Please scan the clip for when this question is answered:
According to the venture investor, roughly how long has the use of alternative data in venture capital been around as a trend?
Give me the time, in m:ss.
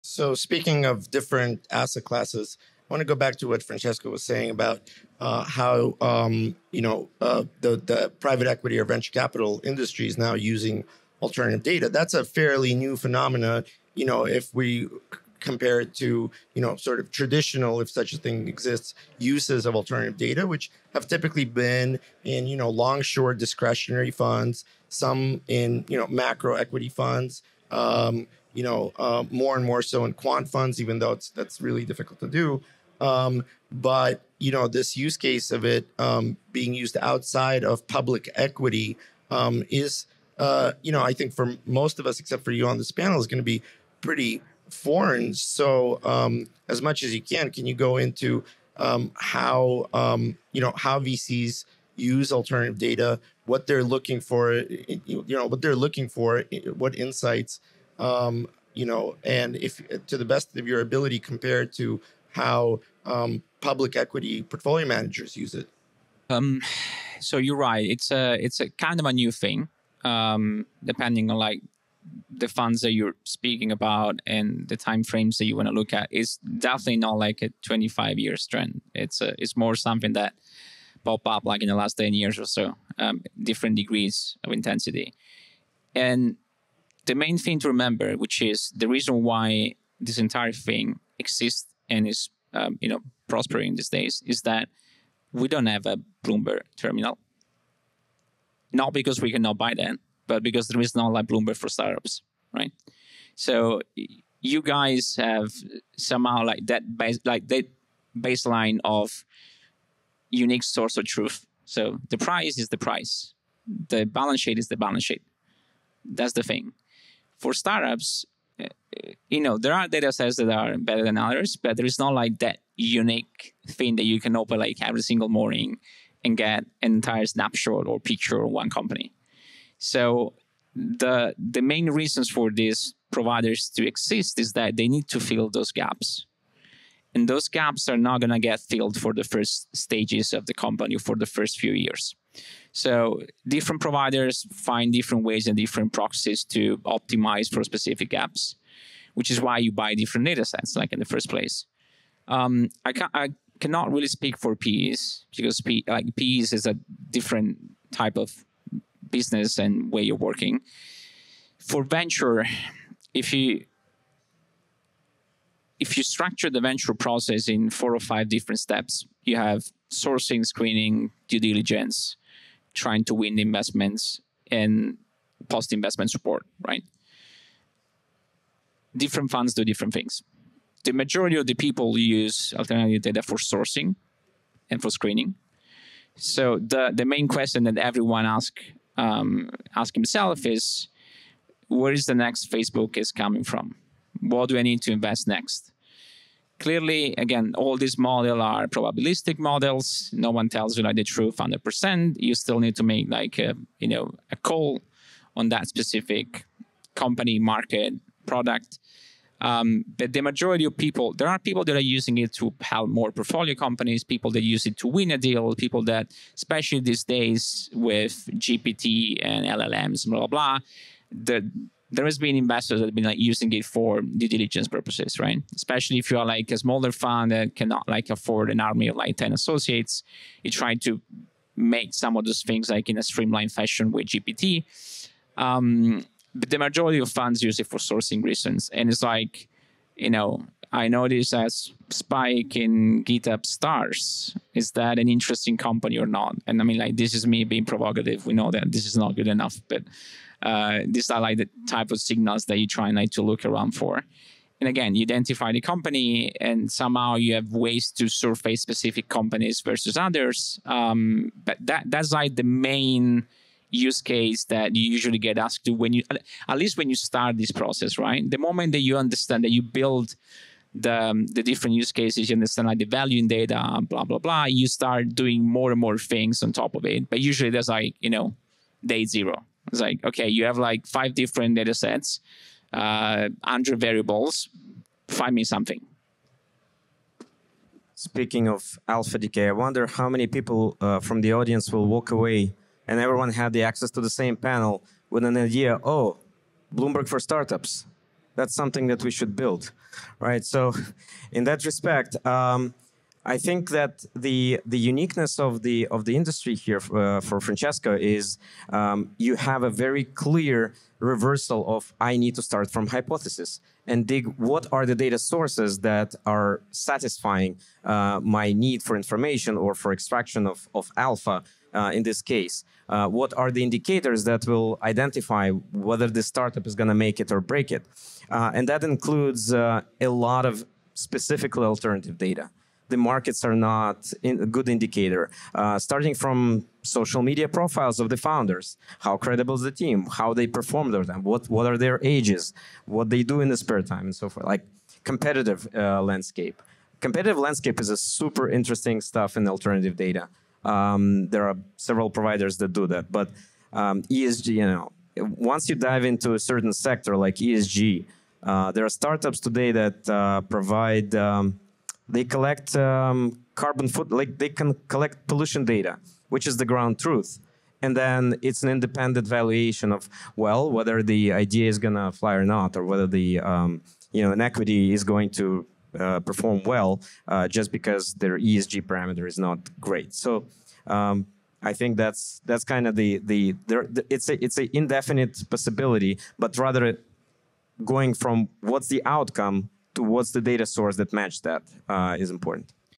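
1:21.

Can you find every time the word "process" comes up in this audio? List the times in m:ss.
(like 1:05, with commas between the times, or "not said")
2:46, 4:27.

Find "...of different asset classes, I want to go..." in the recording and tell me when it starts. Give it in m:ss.
0:00.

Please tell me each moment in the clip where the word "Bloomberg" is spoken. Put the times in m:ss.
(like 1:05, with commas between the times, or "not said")
1:36, 1:41, 4:56.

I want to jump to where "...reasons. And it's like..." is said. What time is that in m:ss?
3:58.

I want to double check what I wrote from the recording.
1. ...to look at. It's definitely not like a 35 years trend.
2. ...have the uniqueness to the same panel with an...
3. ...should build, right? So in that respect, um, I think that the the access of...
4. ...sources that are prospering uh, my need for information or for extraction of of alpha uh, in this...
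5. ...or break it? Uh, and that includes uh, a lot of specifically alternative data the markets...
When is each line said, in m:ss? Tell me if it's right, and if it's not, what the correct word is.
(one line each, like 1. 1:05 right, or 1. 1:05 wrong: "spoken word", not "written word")
1. 1:15 wrong: "25", not "35"
2. 4:53 wrong: "access", not "uniqueness"
3. 4:59 wrong: "uniqueness", not "access"
4. 5:15 wrong: "satisfying", not "prospering"
5. 5:27 right.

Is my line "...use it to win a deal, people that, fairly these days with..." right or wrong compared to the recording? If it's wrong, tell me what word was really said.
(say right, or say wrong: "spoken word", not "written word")
wrong: "especially", not "fairly".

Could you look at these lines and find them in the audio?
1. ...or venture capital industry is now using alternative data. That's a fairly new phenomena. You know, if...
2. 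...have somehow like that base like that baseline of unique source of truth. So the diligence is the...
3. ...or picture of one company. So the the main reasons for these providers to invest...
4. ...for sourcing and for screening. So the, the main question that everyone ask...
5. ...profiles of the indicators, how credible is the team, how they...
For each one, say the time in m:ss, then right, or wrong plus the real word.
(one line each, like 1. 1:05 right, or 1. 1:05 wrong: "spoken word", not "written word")
1. 0:08 right
2. 1:45 wrong: "price", not "diligence"
3. 2:07 wrong: "exist", not "invest"
4. 3:03 right
5. 5:37 wrong: "founders", not "indicators".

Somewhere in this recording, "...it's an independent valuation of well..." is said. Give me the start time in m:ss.
6:08.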